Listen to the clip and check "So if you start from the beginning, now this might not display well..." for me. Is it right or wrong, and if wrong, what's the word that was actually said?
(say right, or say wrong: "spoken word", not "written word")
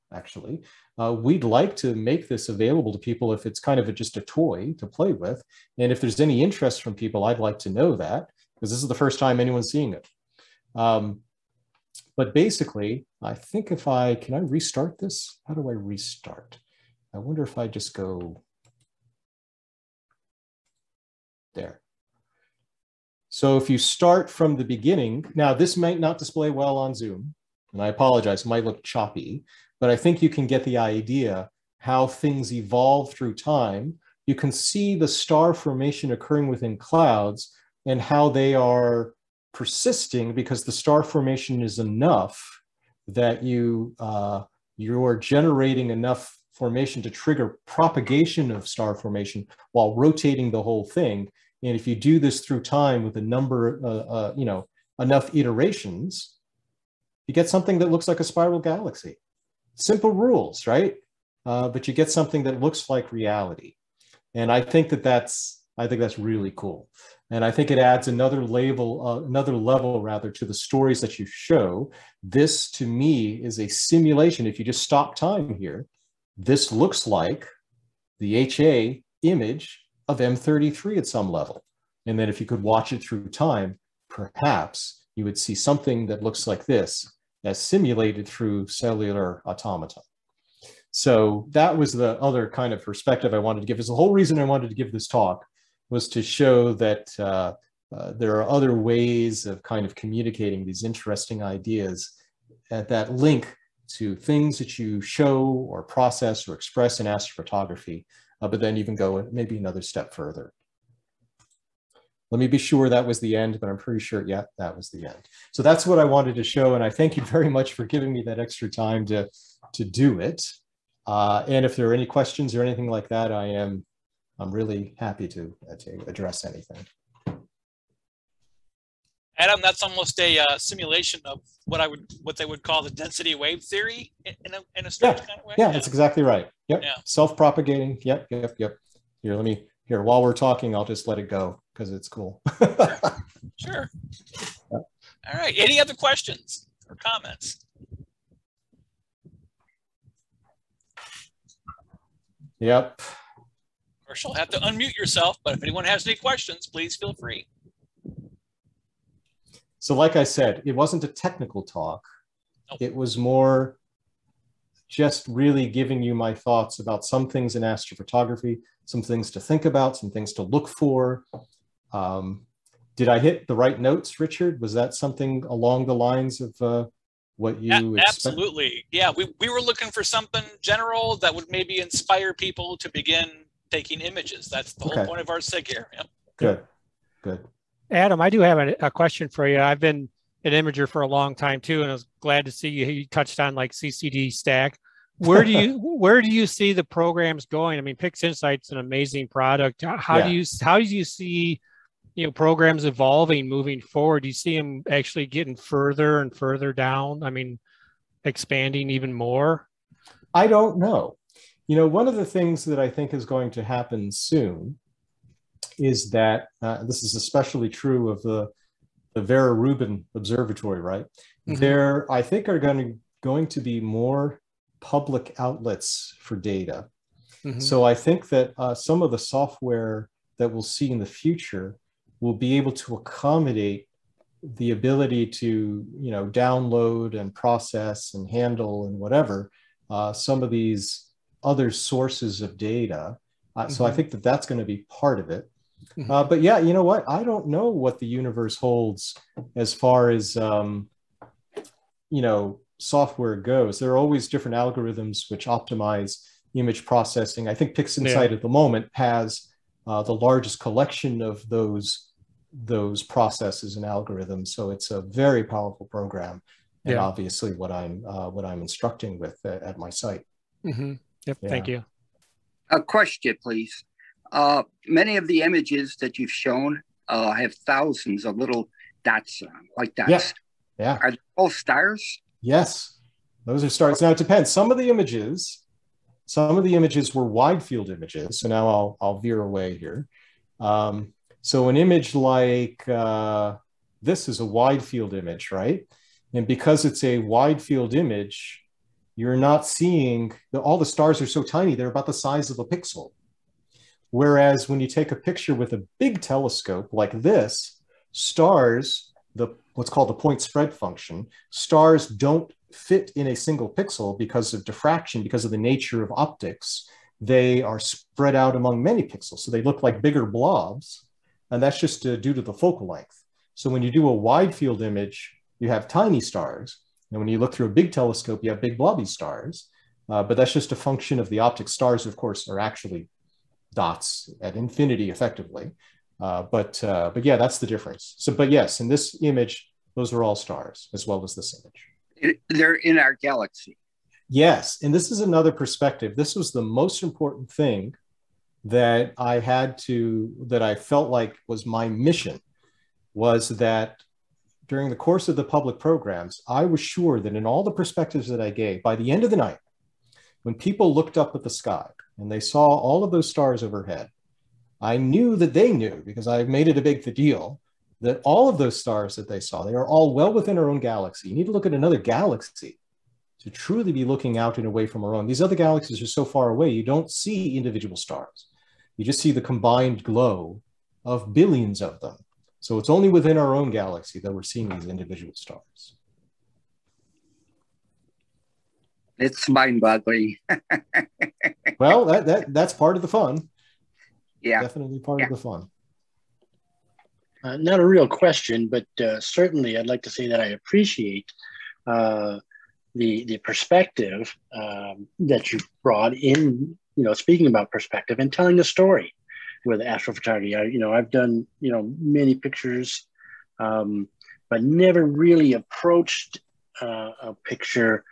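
right.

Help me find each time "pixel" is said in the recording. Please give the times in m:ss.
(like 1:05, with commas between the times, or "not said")
5:02, 5:13, 5:19.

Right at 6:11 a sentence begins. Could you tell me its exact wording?
You need to look at another galaxy to truly be looking out and away from our own.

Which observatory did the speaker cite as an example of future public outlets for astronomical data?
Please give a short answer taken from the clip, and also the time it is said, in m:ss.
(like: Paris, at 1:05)
Vera Rubin Observatory, at 3:39.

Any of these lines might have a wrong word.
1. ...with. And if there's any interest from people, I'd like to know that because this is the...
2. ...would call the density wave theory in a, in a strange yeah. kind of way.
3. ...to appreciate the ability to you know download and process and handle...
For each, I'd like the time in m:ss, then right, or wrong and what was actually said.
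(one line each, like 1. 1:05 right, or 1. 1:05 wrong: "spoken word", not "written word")
1. 0:05 right
2. 2:12 right
3. 3:52 wrong: "accommodate", not "appreciate".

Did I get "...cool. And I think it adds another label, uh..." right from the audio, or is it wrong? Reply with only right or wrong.
right.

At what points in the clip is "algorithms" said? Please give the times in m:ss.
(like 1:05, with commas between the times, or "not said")
4:14, 4:23.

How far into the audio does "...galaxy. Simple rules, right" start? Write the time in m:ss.
0:58.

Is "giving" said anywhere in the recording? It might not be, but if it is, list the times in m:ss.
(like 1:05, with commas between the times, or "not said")
1:57, 2:45.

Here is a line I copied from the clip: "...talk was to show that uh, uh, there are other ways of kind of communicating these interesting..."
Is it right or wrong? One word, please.
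right.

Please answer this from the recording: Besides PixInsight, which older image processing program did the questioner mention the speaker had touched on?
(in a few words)
CCD Stack.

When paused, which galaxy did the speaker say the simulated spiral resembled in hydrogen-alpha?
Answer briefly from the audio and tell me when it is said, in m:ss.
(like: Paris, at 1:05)
M33, at 1:20.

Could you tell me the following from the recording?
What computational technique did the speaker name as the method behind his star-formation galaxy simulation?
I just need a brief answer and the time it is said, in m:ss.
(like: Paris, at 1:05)
cellular automata, at 1:28.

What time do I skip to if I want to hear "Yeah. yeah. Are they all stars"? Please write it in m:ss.
4:40.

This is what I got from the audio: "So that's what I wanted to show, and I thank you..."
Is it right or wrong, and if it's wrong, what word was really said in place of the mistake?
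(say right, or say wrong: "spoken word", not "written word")
right.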